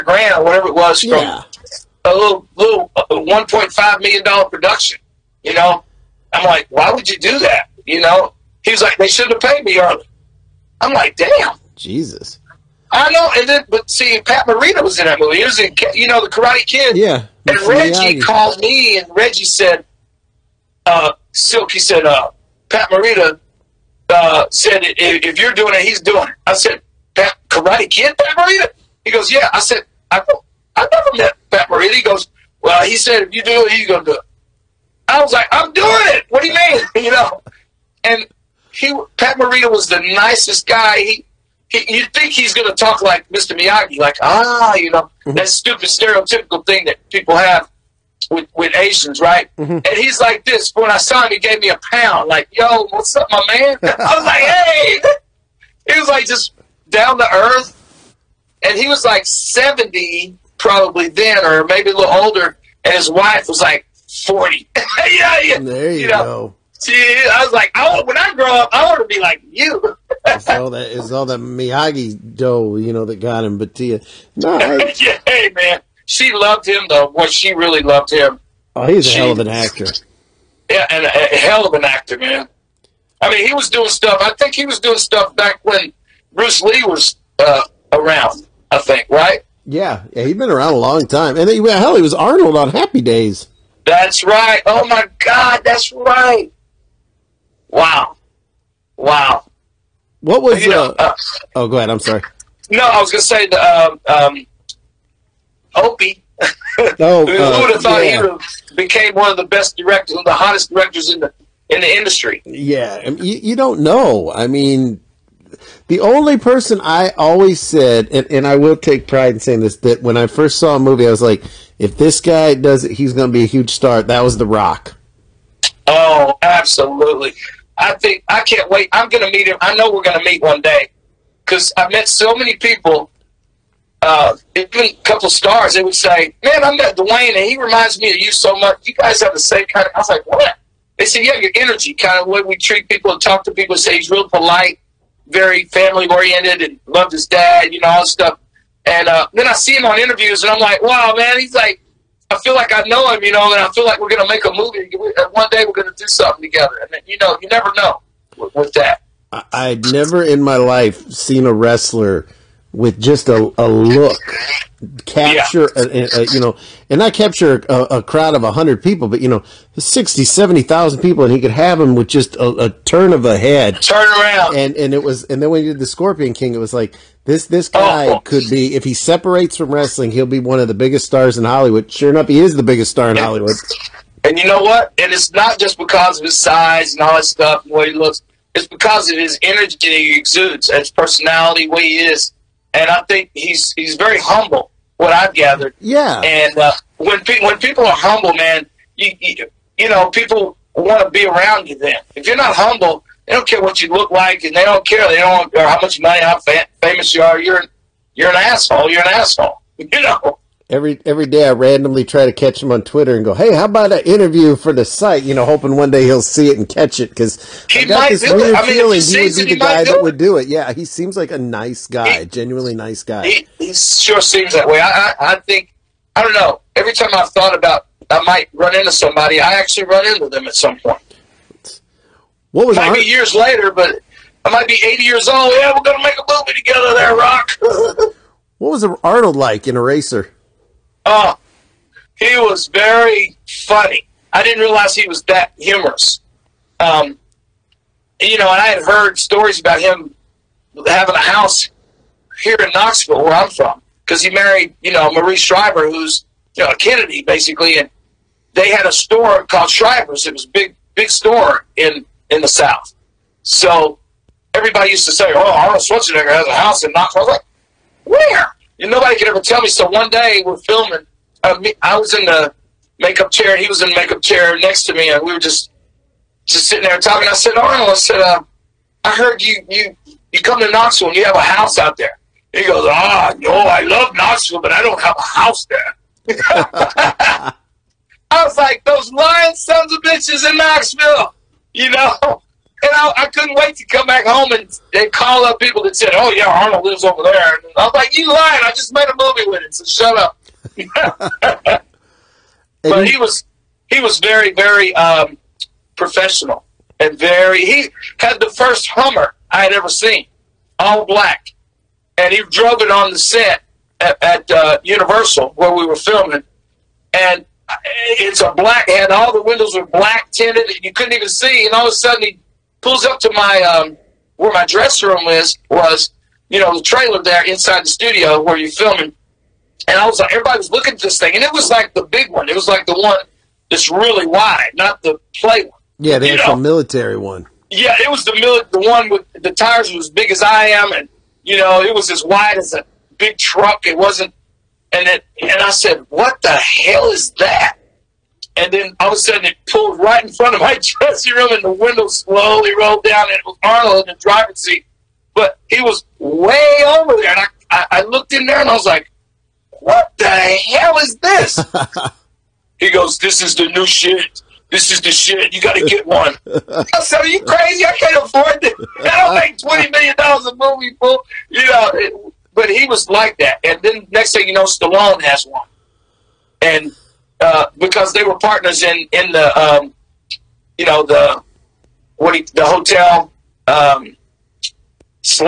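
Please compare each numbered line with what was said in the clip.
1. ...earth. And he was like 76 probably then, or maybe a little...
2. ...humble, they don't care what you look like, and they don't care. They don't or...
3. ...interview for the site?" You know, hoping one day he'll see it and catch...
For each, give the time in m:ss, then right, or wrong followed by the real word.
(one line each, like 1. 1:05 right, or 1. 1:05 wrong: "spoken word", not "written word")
1. 0:57 wrong: "70", not "76"
2. 3:22 right
3. 3:34 right.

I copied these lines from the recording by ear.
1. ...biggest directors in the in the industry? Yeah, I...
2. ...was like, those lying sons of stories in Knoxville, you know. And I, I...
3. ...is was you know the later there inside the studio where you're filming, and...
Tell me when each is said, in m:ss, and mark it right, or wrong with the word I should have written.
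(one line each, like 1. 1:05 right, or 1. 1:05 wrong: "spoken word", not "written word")
1. 1:50 wrong: "hottest", not "biggest"
2. 4:48 wrong: "bitches", not "stories"
3. 5:25 wrong: "trailer", not "later".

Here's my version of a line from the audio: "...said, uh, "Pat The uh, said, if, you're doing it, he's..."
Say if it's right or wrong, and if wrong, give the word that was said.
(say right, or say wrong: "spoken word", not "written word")
wrong: "Morita", not "The".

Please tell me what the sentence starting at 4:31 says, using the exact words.
Uh, me, I was in the makeup chair.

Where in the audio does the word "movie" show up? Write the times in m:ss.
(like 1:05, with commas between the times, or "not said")
0:15, 2:00, 2:34, 3:56, 4:59, 6:10.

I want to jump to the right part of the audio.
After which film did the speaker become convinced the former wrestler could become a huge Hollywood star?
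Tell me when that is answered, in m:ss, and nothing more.
2:55.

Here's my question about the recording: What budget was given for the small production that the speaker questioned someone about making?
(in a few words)
$1.5 million.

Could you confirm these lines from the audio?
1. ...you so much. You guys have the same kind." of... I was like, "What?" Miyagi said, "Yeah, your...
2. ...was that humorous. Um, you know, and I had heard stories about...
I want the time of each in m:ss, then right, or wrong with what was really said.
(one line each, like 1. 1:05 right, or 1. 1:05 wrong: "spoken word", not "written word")
1. 2:18 wrong: "They", not "Miyagi"
2. 4:05 right.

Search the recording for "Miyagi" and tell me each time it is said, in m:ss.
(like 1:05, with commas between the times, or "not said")
0:43, 1:11.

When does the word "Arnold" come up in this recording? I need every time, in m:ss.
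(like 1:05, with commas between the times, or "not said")
1:32, 3:59, 4:25, 4:37, 4:56, 5:53.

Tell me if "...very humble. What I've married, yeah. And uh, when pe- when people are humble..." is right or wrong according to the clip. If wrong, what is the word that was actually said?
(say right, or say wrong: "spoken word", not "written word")
wrong: "gathered", not "married".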